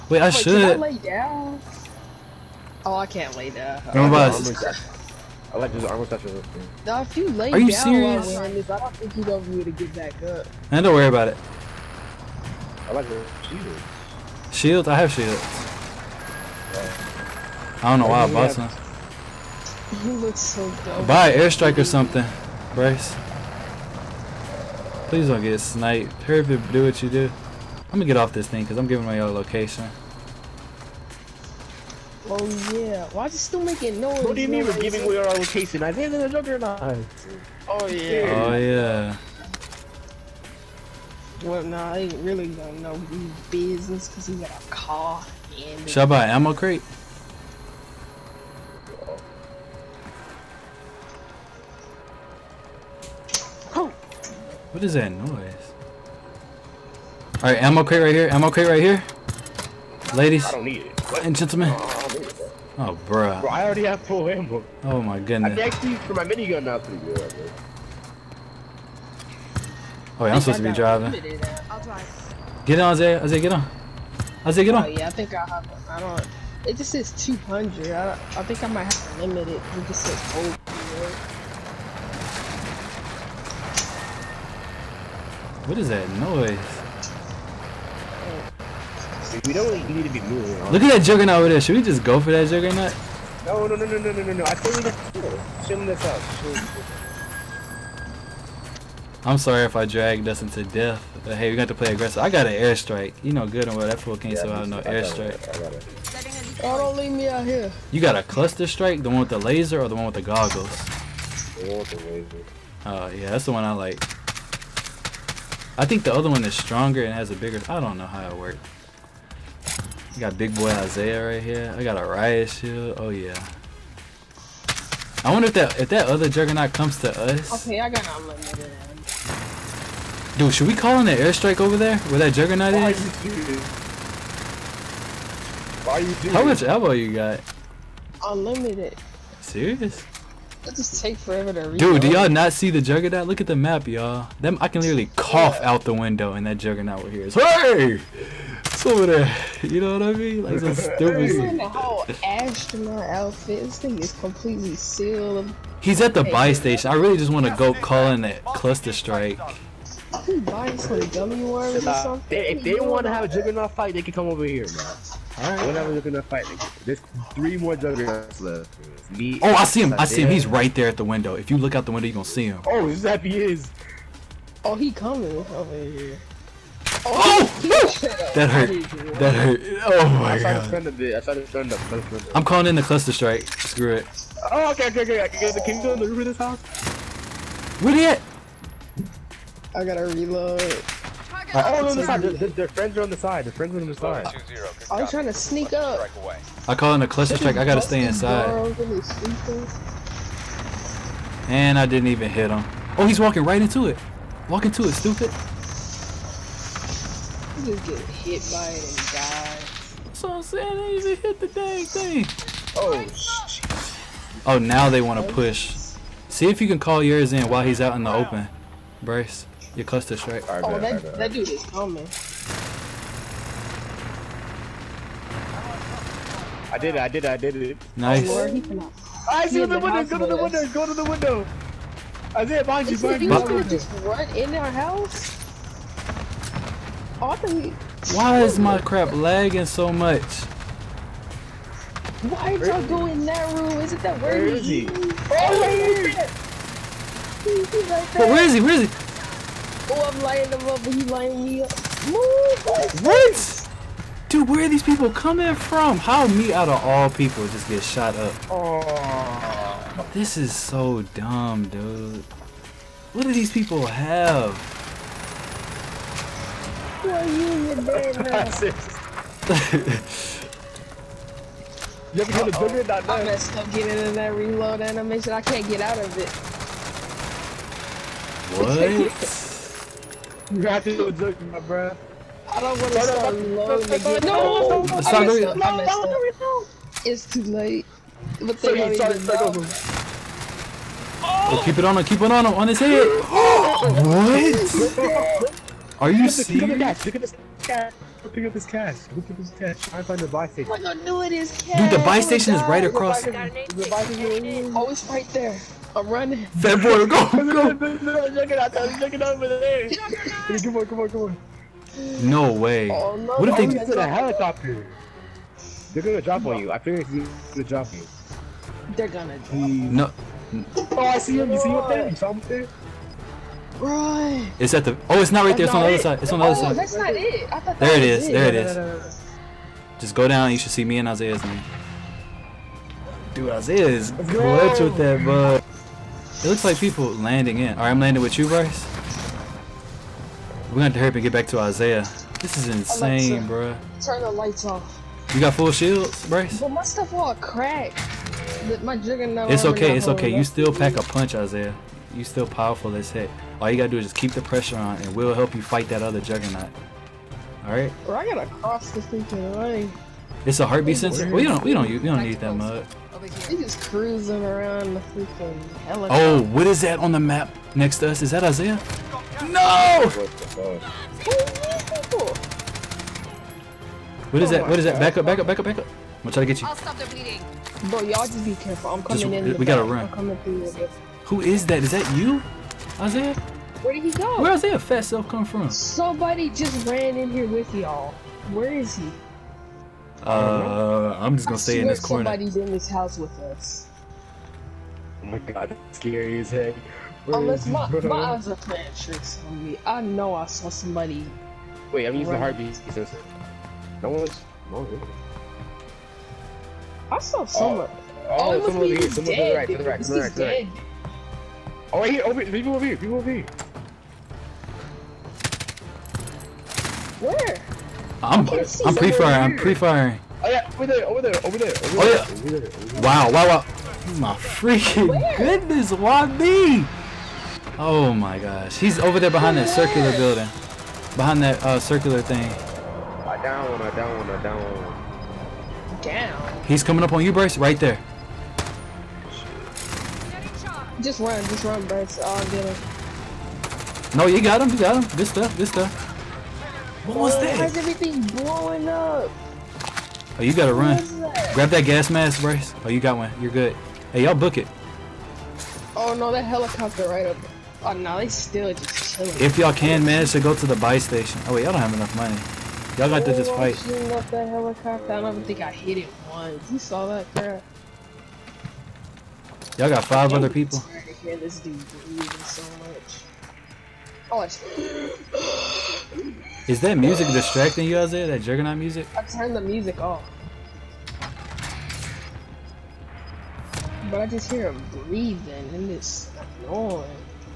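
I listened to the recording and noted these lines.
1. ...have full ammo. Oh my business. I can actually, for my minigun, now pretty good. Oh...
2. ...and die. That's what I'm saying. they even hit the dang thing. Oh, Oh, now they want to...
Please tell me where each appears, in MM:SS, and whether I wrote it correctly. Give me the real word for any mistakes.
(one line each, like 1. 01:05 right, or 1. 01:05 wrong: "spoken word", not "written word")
1. 01:03 wrong: "goodness", not "business"
2. 03:28 right.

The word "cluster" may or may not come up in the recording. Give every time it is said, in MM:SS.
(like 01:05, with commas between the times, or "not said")
01:48, 02:38, 03:02, 03:17.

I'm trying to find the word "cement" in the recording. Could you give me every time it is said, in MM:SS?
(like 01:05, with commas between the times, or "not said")
not said.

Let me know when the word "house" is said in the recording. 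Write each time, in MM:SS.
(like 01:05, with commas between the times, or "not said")
03:06, 03:54, 06:32.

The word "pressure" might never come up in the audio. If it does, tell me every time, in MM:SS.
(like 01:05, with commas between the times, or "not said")
05:54.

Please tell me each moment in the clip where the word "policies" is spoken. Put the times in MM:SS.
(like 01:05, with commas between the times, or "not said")
not said.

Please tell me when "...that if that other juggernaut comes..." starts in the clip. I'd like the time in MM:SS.
02:05.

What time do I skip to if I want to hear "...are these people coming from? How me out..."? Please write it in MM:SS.
04:14.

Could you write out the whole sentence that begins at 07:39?
If y'all can manage to go to the buy station.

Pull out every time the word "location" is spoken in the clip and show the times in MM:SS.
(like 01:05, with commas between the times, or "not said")
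00:29, 00:35.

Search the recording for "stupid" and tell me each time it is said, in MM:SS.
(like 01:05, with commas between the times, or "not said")
02:30, 03:24.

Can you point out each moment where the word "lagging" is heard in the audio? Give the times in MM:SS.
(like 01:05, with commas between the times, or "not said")
03:59.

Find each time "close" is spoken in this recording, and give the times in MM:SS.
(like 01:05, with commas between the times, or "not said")
03:39.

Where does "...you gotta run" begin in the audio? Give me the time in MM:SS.
07:30.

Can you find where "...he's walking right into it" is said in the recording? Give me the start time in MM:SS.
03:23.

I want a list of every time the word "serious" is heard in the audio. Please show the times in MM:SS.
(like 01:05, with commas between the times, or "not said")
00:07, 02:19, 04:56.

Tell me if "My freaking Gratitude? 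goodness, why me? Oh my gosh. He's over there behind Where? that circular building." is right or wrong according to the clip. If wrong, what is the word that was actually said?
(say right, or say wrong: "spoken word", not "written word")
wrong: "Where", not "Gratitude".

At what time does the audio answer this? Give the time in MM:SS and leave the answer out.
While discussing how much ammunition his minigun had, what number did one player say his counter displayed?
01:16.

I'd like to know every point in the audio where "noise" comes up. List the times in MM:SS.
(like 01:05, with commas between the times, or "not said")
00:34, 00:55, 01:26.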